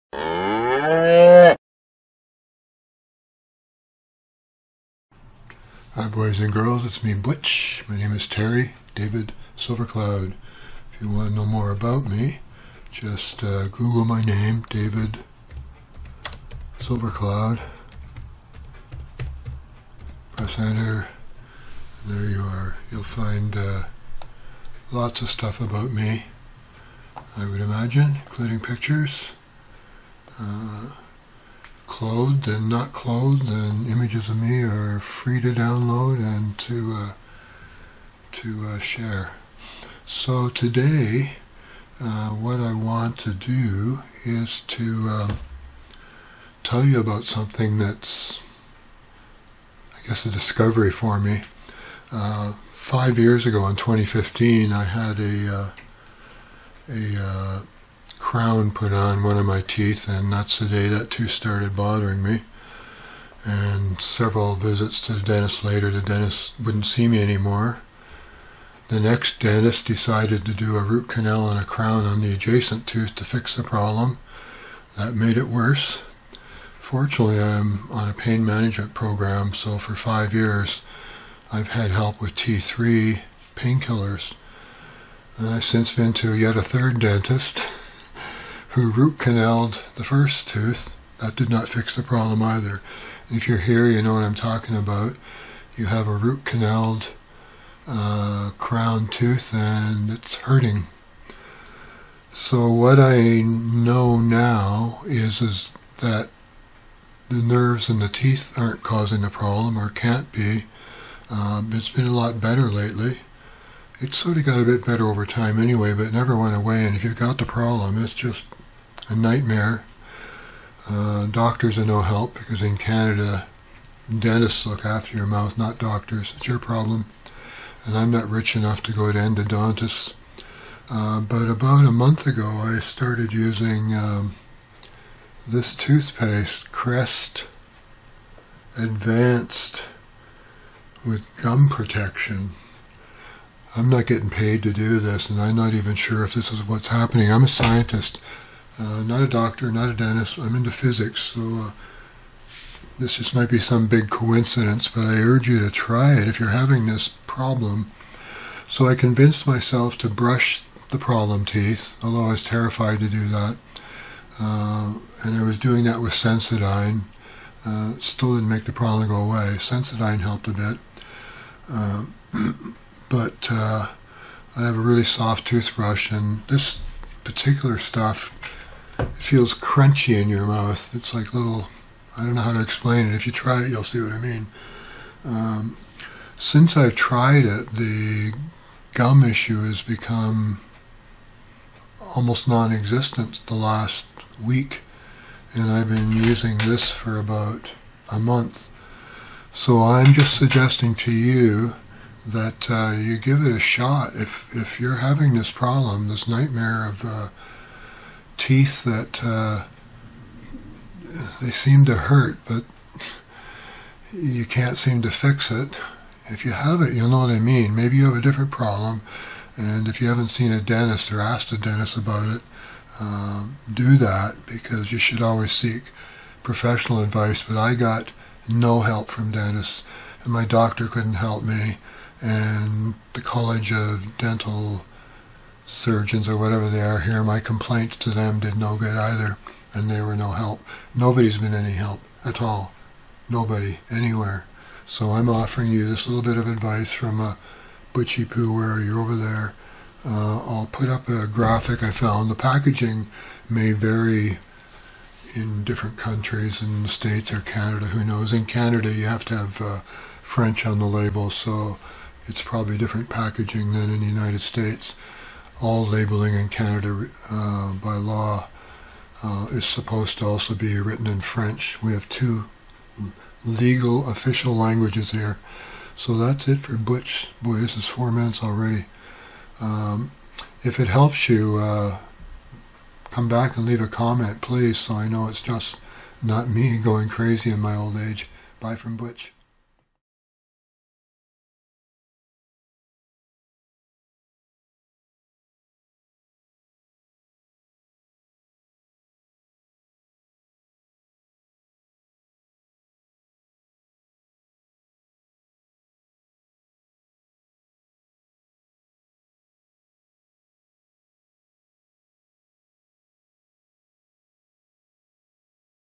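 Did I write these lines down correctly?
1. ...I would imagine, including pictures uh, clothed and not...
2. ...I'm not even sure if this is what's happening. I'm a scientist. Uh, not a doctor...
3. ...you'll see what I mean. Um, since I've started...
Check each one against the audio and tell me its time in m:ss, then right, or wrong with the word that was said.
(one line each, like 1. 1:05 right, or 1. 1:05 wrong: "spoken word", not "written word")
1. 0:27 right
2. 2:25 right
3. 3:03 wrong: "tried", not "started".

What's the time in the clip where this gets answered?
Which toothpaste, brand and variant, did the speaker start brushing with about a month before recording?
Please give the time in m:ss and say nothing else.
2:16.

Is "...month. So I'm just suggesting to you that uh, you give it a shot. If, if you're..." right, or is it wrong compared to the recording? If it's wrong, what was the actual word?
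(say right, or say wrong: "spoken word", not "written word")
right.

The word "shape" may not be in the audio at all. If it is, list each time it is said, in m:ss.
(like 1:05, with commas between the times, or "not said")
not said.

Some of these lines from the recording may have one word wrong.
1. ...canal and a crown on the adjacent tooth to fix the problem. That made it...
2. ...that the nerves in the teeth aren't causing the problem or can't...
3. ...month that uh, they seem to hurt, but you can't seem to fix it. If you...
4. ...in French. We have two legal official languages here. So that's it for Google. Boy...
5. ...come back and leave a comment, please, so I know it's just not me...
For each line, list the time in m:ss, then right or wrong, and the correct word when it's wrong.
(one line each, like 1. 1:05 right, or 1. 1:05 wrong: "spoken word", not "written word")
1. 1:11 right
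2. 1:45 right
3. 3:28 wrong: "teeth", not "month"
4. 4:31 wrong: "Butch", not "Google"
5. 4:43 right.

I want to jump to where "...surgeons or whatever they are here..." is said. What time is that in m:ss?
3:55.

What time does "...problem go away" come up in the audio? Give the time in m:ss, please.
2:48.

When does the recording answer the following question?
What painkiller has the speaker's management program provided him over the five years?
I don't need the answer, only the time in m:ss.
1:22.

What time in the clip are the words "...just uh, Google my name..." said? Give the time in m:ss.
0:12.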